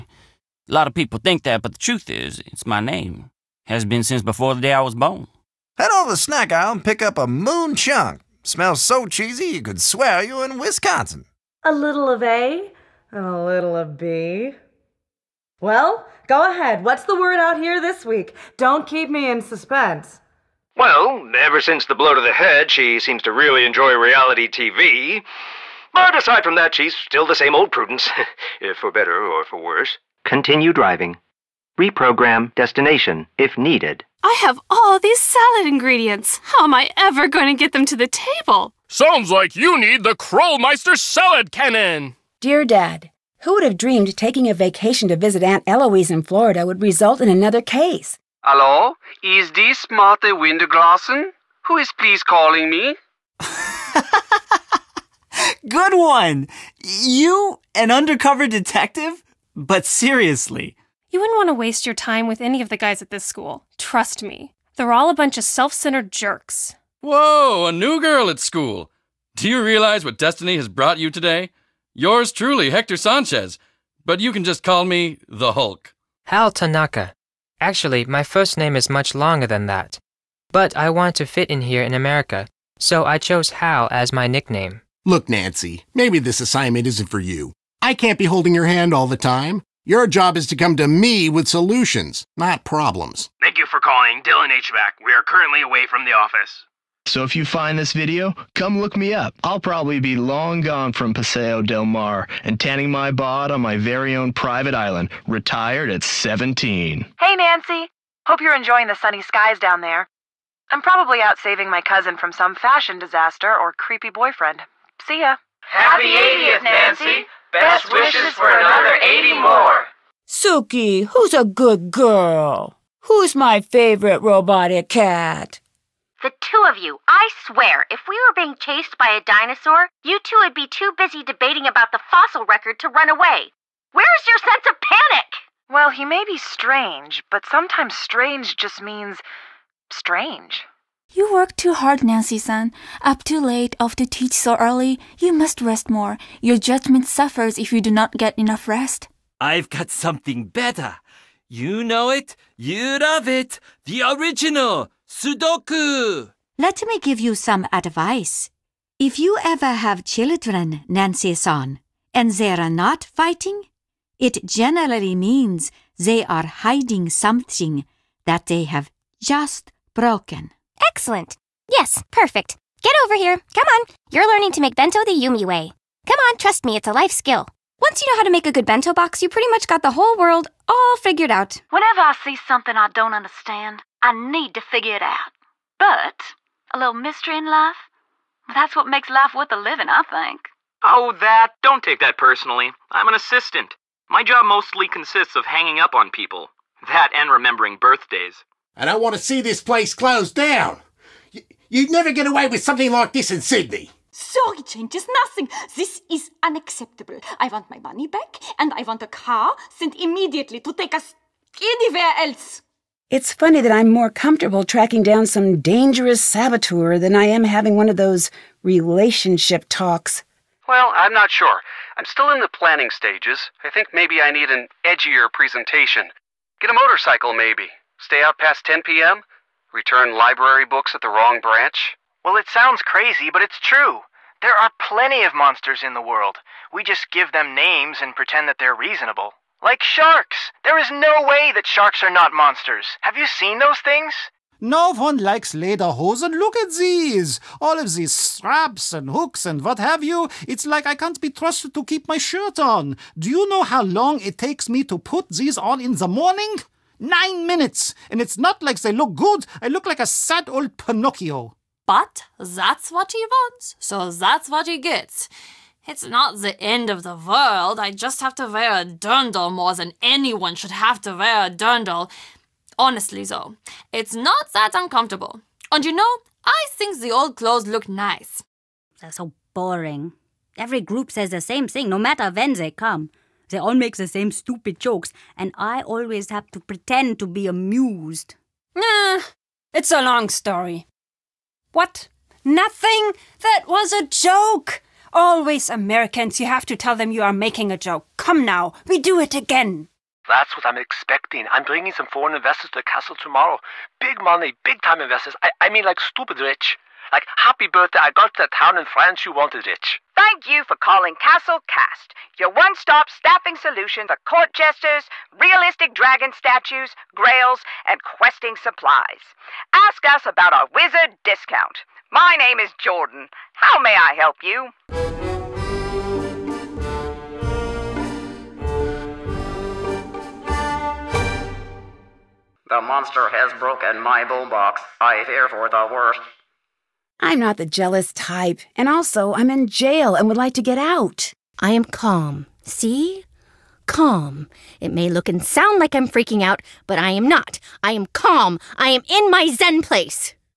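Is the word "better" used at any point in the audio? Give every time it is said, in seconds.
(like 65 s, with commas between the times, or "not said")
28 s, 150 s.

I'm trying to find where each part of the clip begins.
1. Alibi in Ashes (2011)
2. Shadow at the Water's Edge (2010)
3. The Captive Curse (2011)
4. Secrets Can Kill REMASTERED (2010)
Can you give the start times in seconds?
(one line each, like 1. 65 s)
1. 336 s
2. 119 s
3. 212 s
4. 42 s.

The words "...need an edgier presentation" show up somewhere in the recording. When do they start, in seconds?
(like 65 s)
224 s.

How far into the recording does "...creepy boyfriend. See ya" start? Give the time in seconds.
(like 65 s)
113 s.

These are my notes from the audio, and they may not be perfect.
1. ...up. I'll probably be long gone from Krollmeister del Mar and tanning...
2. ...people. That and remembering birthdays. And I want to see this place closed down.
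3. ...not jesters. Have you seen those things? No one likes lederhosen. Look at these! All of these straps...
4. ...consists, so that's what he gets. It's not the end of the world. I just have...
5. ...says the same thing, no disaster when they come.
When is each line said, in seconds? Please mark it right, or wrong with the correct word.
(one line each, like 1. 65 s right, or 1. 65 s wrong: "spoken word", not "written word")
1. 99 s wrong: "Paseo", not "Krollmeister"
2. 196 s right
3. 242 s wrong: "monsters", not "jesters"
4. 263 s wrong: "wants", not "consists"
5. 281 s wrong: "matter", not "disaster".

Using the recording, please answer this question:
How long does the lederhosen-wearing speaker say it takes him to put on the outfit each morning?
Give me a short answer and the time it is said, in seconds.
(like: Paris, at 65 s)
9 minutes, at 257 s.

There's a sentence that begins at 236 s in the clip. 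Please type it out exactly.
We just give them names and pretend that they're reasonable.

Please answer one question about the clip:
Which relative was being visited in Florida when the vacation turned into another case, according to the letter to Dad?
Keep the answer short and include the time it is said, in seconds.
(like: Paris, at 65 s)
Aunt Eloise, at 45 s.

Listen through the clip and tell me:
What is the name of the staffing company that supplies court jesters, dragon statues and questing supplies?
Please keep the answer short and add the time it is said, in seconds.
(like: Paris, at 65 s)
Castle Cast, at 311 s.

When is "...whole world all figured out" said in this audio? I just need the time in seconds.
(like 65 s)
179 s.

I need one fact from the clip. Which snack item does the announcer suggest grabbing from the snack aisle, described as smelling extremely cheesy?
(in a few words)
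moon chunk.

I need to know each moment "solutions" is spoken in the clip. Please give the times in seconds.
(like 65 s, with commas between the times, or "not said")
91 s, 313 s.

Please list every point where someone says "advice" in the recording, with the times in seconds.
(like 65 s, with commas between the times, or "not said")
157 s.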